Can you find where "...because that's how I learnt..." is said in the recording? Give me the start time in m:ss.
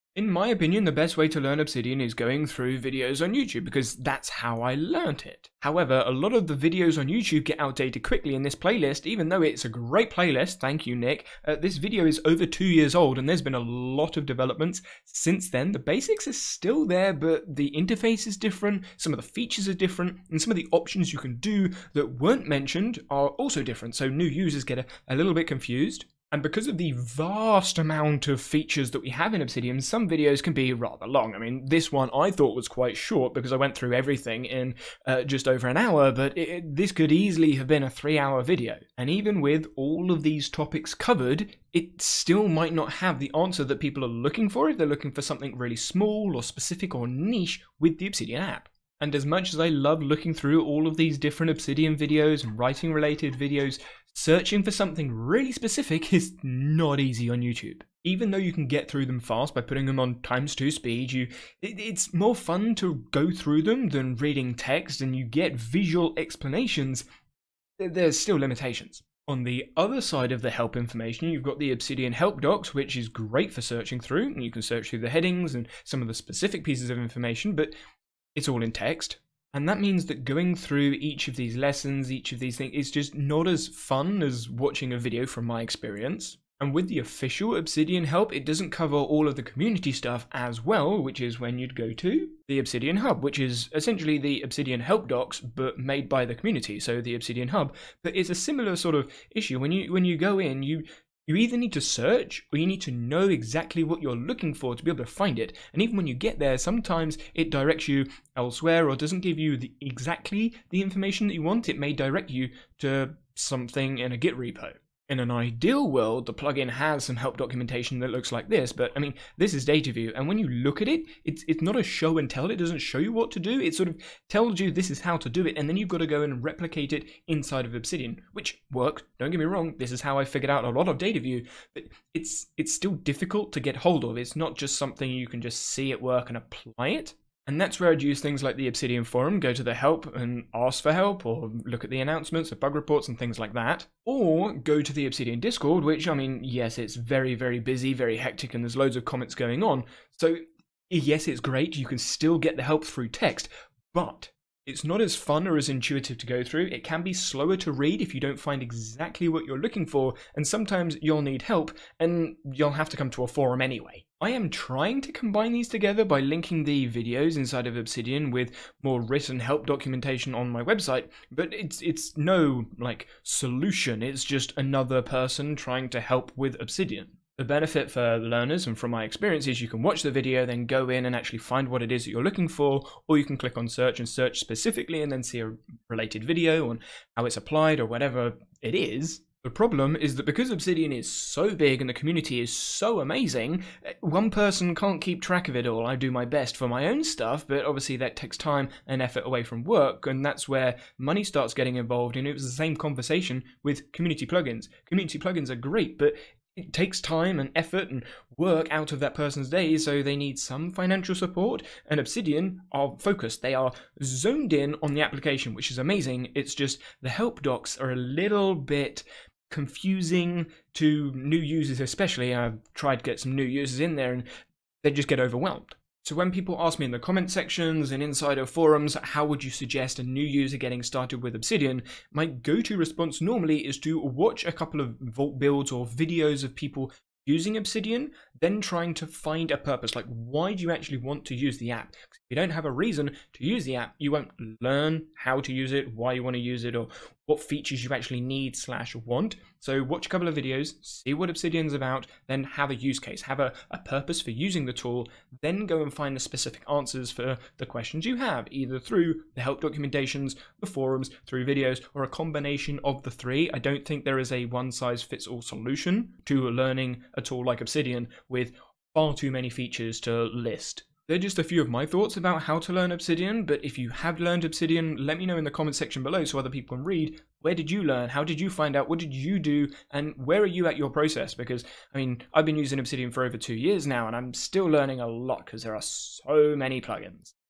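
0:03.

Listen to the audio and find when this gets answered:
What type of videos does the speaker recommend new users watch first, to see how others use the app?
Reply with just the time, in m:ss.
3:54.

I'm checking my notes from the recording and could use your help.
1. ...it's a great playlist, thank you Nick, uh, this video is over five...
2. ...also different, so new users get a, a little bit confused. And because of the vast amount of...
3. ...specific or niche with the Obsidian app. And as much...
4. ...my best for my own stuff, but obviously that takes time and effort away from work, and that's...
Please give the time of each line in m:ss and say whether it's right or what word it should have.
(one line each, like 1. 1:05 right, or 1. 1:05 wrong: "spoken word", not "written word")
1. 0:09 wrong: "two", not "five"
2. 0:23 right
3. 0:46 right
4. 3:16 right.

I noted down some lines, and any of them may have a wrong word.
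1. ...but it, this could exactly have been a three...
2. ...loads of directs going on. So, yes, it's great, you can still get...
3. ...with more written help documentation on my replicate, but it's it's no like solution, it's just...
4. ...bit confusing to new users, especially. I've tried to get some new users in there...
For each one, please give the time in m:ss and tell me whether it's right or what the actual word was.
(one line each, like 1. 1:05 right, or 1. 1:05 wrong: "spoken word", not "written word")
1. 0:36 wrong: "easily", not "exactly"
2. 2:28 wrong: "comments", not "directs"
3. 2:48 wrong: "website", not "replicate"
4. 3:38 right.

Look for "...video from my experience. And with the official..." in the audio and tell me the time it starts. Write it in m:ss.
1:24.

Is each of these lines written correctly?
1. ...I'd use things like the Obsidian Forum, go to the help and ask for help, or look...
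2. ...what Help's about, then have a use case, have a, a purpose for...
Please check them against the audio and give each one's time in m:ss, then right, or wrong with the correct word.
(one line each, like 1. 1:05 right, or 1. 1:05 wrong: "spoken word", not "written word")
1. 2:17 right
2. 4:11 wrong: "Obsidian", not "Help".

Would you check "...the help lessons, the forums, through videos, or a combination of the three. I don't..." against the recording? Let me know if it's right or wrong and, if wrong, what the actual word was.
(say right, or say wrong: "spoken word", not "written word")
wrong: "documentations", not "lessons".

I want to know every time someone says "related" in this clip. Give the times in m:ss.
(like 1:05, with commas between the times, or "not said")
0:52, 3:05.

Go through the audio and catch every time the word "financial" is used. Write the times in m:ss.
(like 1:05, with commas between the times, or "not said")
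3:30.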